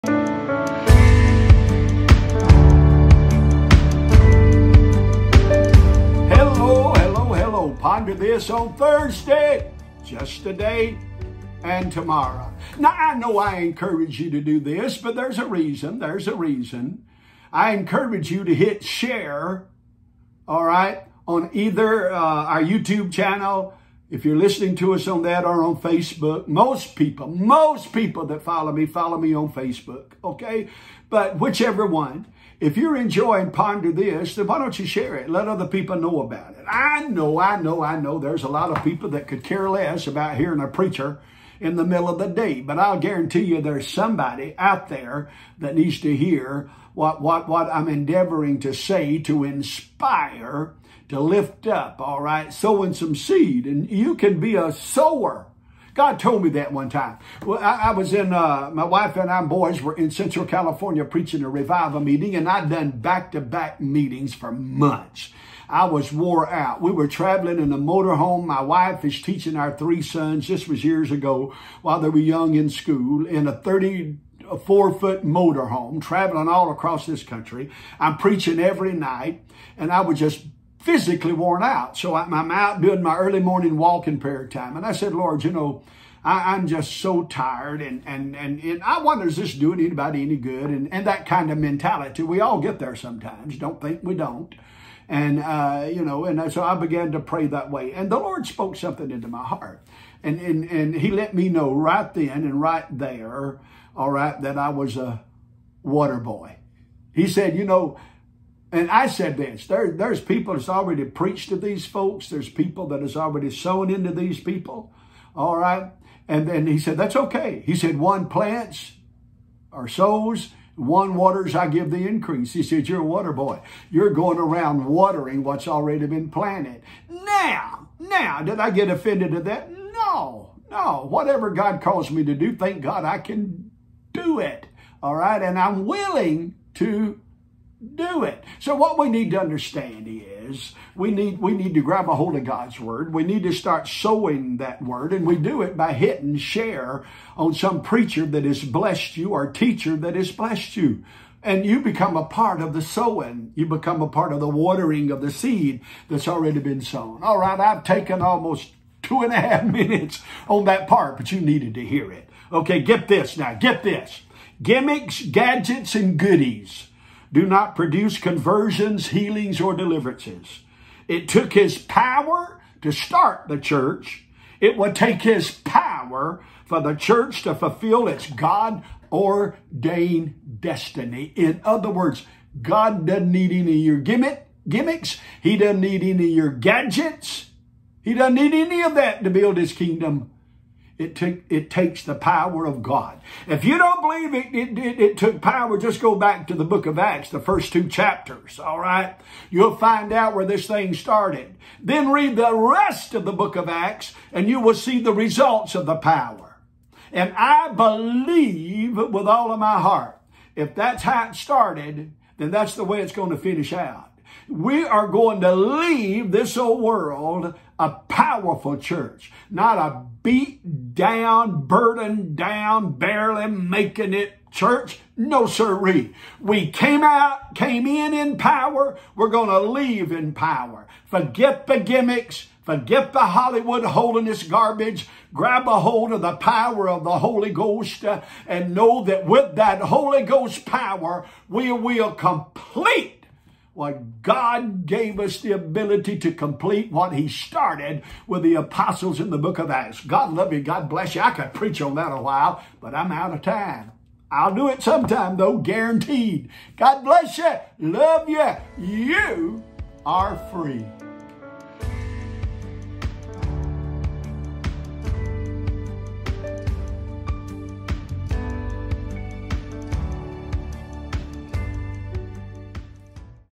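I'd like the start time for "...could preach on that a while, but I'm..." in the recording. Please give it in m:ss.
4:11.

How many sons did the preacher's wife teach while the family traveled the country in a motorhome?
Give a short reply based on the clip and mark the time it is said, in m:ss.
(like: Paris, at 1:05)
3, at 1:09.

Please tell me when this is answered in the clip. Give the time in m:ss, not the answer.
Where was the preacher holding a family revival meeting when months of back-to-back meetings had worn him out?
1:00.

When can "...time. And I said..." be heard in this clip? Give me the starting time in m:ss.
1:24.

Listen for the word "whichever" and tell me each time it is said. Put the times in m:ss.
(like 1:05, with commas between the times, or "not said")
0:31.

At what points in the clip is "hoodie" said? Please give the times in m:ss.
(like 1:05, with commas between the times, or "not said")
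not said.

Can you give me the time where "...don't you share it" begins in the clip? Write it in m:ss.
0:34.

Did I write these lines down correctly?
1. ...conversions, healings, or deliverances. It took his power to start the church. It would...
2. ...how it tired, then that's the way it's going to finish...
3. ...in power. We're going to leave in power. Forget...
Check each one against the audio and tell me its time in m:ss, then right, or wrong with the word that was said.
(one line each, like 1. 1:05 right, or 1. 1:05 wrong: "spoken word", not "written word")
1. 2:48 right
2. 3:31 wrong: "started", not "tired"
3. 3:48 right.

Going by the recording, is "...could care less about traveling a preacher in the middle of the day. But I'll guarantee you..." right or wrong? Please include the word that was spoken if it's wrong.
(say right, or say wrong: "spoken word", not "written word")
wrong: "hearing", not "traveling".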